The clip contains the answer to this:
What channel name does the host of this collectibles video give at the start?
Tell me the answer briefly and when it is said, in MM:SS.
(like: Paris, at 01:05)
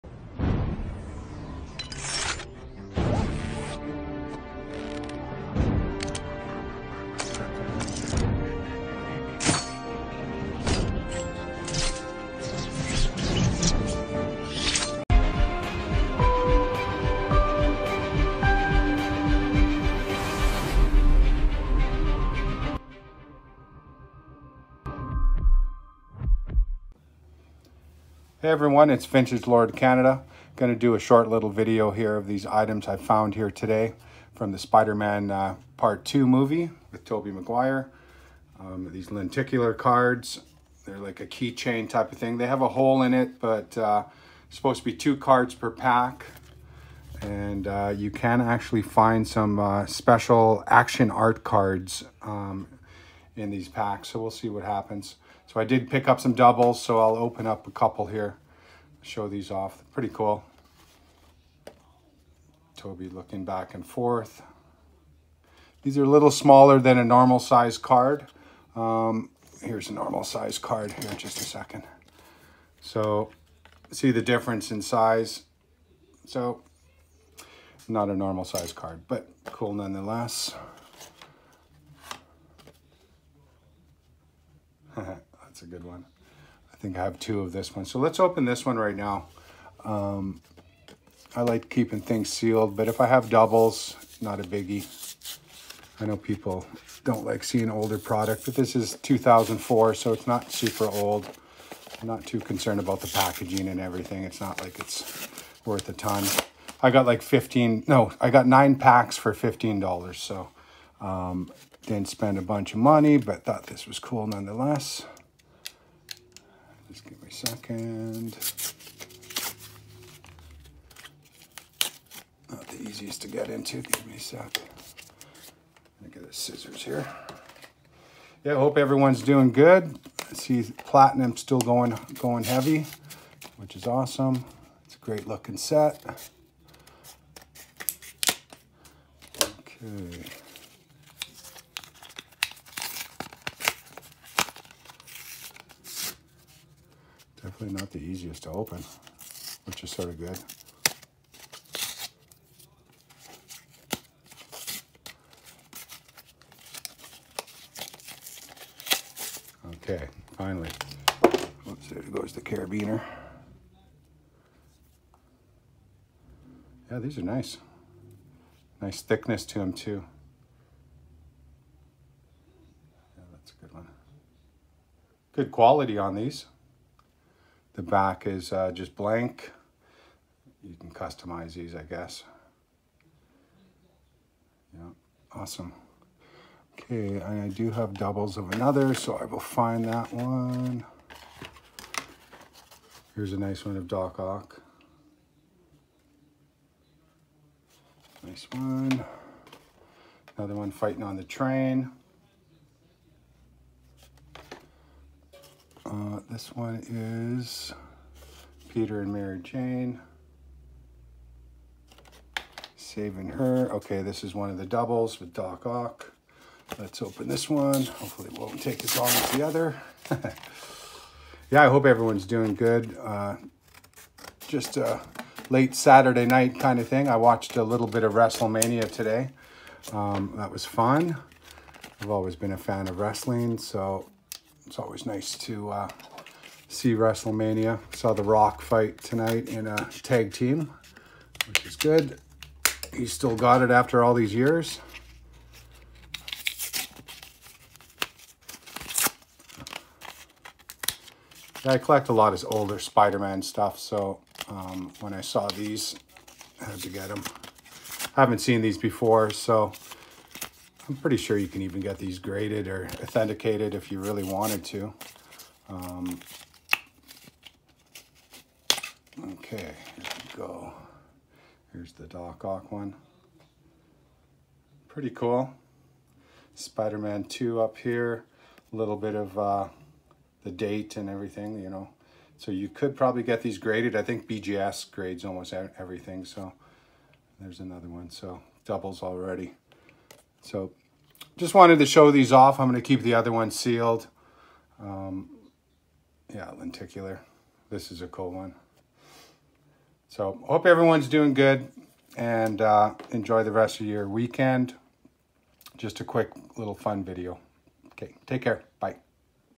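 Vintage Lord Canada, at 00:29.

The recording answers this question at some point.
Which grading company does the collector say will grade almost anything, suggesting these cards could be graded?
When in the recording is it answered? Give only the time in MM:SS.
04:44.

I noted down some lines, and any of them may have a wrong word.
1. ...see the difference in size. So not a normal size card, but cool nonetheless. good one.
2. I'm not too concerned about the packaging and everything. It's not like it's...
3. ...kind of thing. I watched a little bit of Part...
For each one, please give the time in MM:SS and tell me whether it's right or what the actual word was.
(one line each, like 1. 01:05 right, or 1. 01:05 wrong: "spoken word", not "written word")
1. 01:13 right
2. 01:42 right
3. 03:46 wrong: "WrestleMania", not "Part".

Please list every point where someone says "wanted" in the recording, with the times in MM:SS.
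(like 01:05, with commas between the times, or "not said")
04:24, 04:51.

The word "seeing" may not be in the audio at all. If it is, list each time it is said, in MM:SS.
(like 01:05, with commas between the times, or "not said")
01:37.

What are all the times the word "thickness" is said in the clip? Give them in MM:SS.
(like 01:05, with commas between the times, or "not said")
02:49.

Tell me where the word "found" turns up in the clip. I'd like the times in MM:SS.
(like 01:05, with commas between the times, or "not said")
00:32.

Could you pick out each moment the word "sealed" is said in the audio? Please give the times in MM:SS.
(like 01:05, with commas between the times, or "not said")
01:32, 04:53.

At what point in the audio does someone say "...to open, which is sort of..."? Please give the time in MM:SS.
02:28.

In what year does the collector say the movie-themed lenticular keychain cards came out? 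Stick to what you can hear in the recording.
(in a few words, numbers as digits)
2004.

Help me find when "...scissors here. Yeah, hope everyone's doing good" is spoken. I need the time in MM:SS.
02:06.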